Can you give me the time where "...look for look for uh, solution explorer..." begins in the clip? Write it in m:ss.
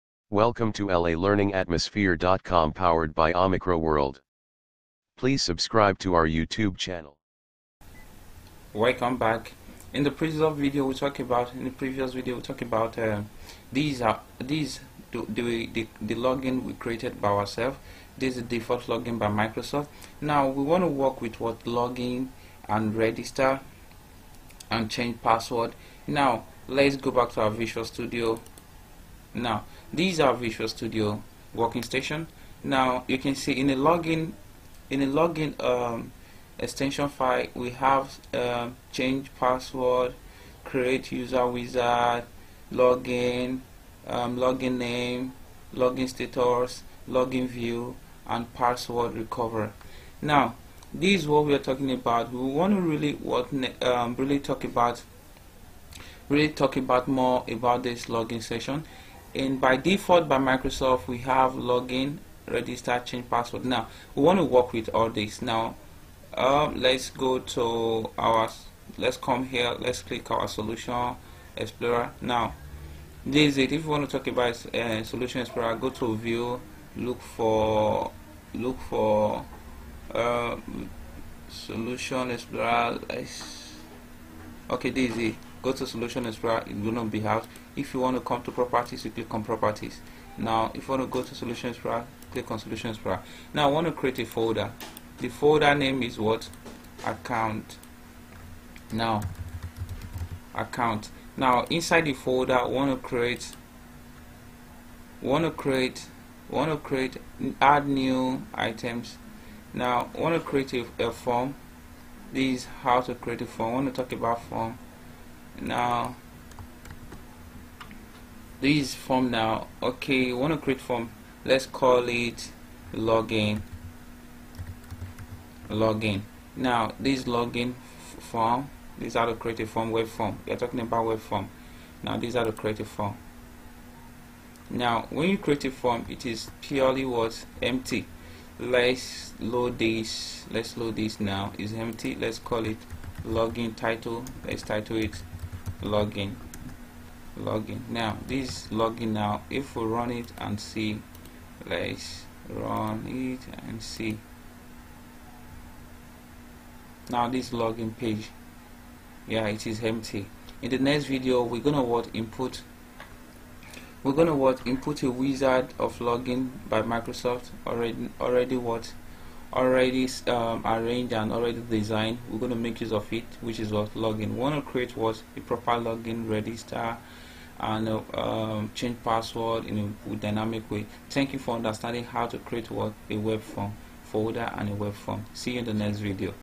1:16.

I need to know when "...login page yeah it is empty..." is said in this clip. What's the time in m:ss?
2:37.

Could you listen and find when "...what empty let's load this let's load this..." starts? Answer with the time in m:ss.
2:17.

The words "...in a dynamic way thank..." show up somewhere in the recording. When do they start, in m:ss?
2:59.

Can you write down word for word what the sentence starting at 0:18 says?
This is the default login by Microsoft.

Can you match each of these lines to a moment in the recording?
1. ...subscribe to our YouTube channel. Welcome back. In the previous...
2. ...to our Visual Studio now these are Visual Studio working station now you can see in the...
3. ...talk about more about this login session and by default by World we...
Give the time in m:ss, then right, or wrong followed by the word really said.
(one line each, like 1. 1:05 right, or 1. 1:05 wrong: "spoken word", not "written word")
1. 0:05 right
2. 0:27 right
3. 0:56 wrong: "Microsoft", not "World".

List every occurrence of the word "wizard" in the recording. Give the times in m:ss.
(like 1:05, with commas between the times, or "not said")
0:41, 2:45.